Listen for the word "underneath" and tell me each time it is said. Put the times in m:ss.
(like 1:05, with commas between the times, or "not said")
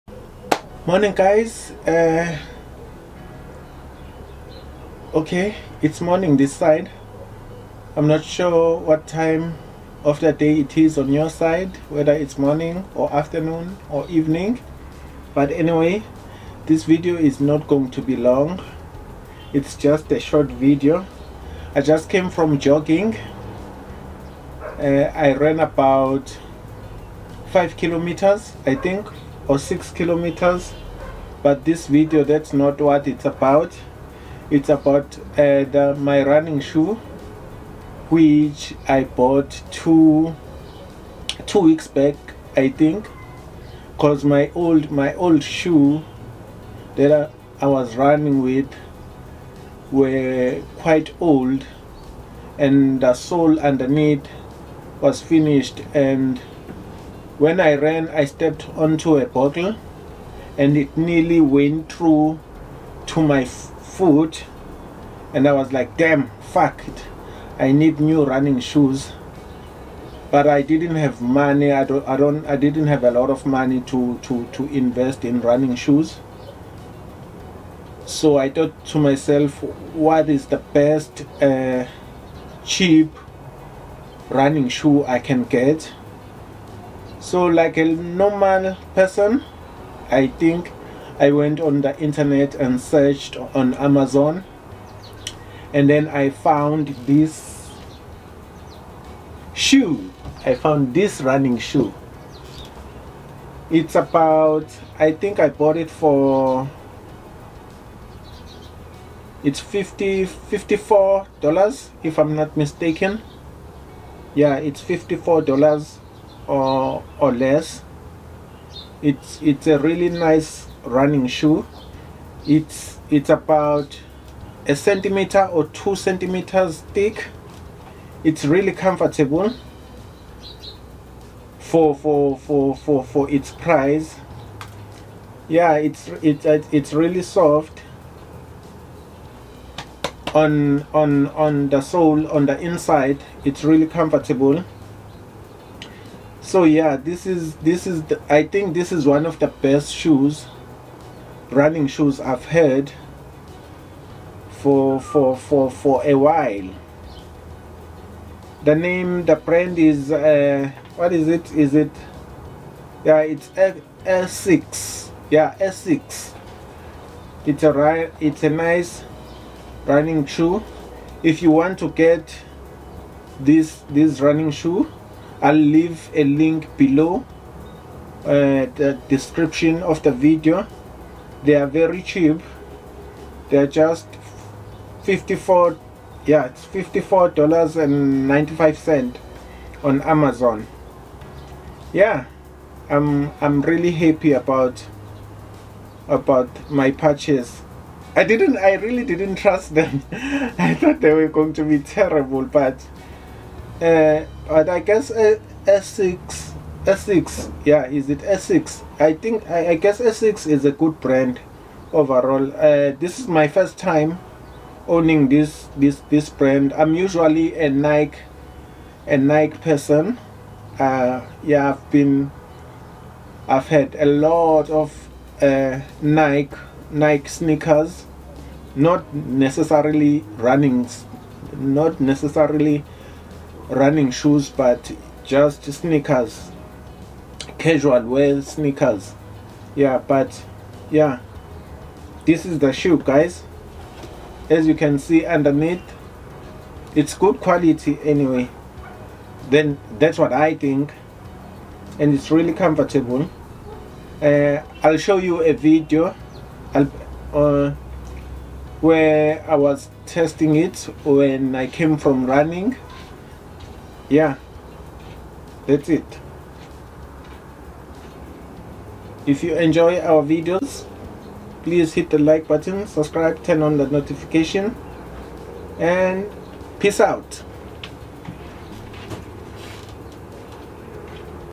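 0:53, 4:05.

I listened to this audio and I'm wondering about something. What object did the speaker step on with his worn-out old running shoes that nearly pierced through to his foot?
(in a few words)
a bottle.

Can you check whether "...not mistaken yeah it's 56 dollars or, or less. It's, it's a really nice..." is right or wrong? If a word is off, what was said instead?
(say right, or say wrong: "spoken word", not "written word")
wrong: "54", not "56".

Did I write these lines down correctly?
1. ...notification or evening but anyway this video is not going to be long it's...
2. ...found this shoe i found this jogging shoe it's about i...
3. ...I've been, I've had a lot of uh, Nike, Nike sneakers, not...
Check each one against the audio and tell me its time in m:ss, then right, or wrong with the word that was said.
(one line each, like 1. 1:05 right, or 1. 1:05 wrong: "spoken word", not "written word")
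1. 0:13 wrong: "afternoon", not "notification"
2. 1:36 wrong: "running", not "jogging"
3. 3:41 right.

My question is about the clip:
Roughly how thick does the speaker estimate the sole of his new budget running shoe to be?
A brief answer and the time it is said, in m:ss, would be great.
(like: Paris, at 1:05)
1 or 2 centimeters, at 2:04.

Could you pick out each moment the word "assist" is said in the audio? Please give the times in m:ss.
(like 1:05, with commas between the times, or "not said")
not said.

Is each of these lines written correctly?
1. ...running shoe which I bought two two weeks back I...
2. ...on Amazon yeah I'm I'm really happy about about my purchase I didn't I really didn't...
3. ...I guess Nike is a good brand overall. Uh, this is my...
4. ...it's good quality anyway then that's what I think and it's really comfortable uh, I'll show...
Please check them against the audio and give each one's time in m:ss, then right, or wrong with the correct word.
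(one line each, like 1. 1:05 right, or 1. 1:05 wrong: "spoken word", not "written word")
1. 0:36 right
2. 3:09 right
3. 3:29 wrong: "Essex", not "Nike"
4. 4:06 right.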